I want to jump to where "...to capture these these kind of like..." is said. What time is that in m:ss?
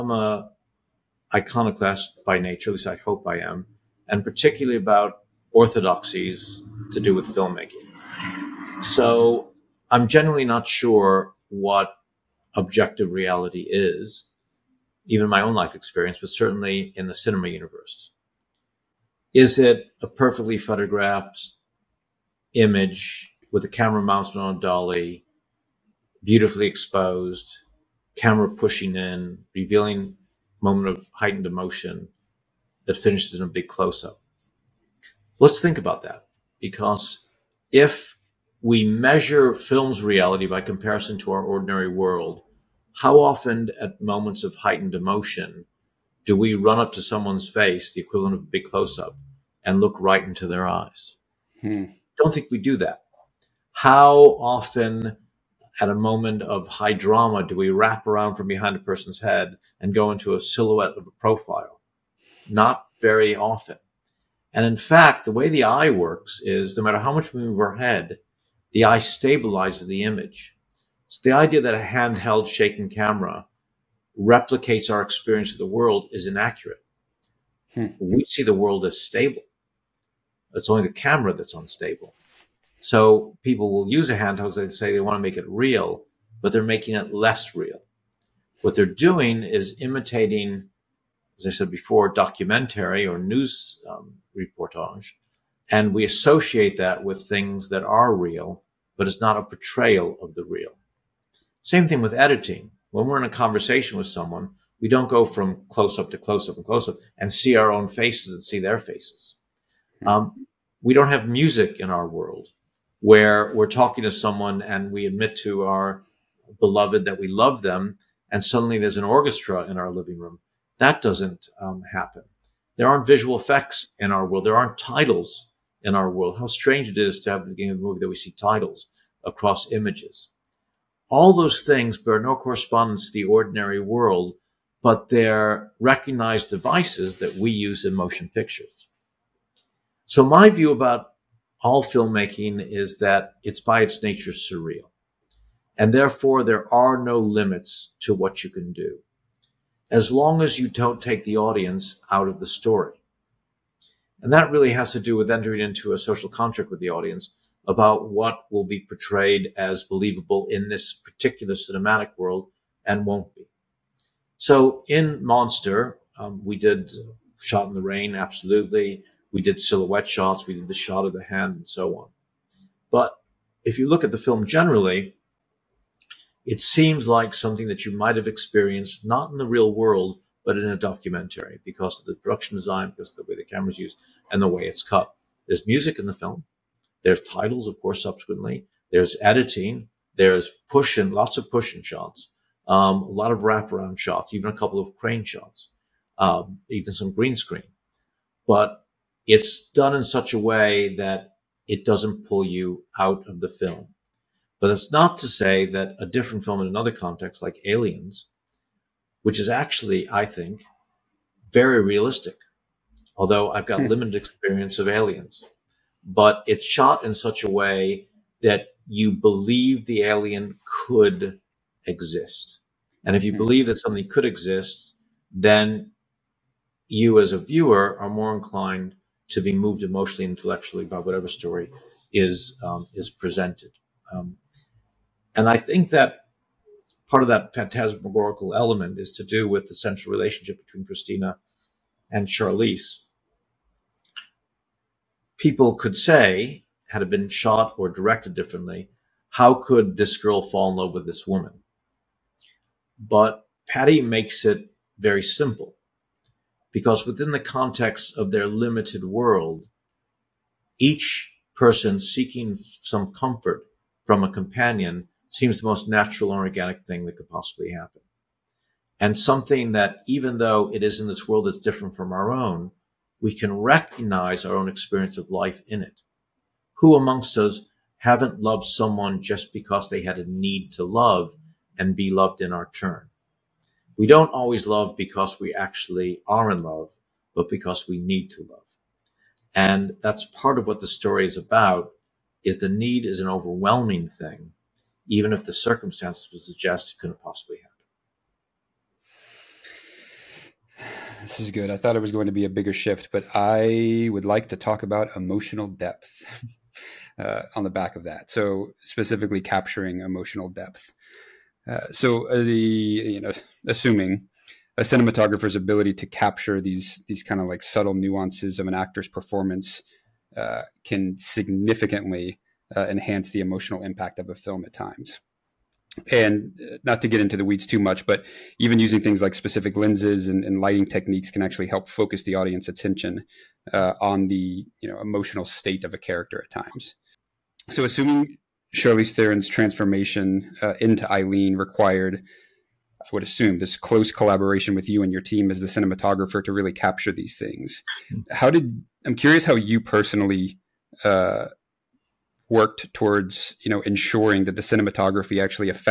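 5:15.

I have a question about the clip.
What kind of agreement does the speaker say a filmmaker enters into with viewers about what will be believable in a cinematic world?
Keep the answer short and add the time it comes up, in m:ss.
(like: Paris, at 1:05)
social contract, at 2:35.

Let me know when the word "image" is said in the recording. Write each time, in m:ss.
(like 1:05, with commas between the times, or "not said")
0:22, 1:10, 2:09.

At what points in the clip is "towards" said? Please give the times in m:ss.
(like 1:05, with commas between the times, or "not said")
5:52.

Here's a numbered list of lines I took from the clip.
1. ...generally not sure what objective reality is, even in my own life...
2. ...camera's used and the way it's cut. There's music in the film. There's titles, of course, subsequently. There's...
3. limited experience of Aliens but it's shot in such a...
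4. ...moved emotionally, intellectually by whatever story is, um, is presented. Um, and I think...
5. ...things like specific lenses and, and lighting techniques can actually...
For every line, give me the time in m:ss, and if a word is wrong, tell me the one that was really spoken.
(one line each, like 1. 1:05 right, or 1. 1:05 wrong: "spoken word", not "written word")
1. 0:10 right
2. 3:03 right
3. 3:33 right
4. 3:49 right
5. 5:29 right.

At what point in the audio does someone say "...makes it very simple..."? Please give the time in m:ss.
4:14.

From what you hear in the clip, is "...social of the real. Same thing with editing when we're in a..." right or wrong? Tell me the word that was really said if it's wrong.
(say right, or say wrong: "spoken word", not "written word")
wrong: "portrayal", not "social".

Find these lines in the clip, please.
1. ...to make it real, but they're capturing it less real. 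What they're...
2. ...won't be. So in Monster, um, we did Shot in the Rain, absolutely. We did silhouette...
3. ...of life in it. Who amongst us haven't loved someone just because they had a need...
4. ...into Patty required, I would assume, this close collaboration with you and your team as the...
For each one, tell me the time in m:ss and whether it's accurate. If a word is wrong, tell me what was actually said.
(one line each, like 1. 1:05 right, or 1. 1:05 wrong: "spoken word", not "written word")
1. 1:25 wrong: "making", not "capturing"
2. 2:43 right
3. 4:35 right
4. 5:40 wrong: "Aileen", not "Patty".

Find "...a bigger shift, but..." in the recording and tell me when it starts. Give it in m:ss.
5:02.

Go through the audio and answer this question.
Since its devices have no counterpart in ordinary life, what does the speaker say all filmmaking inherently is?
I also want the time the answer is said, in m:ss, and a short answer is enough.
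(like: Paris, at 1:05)
surreal, at 2:24.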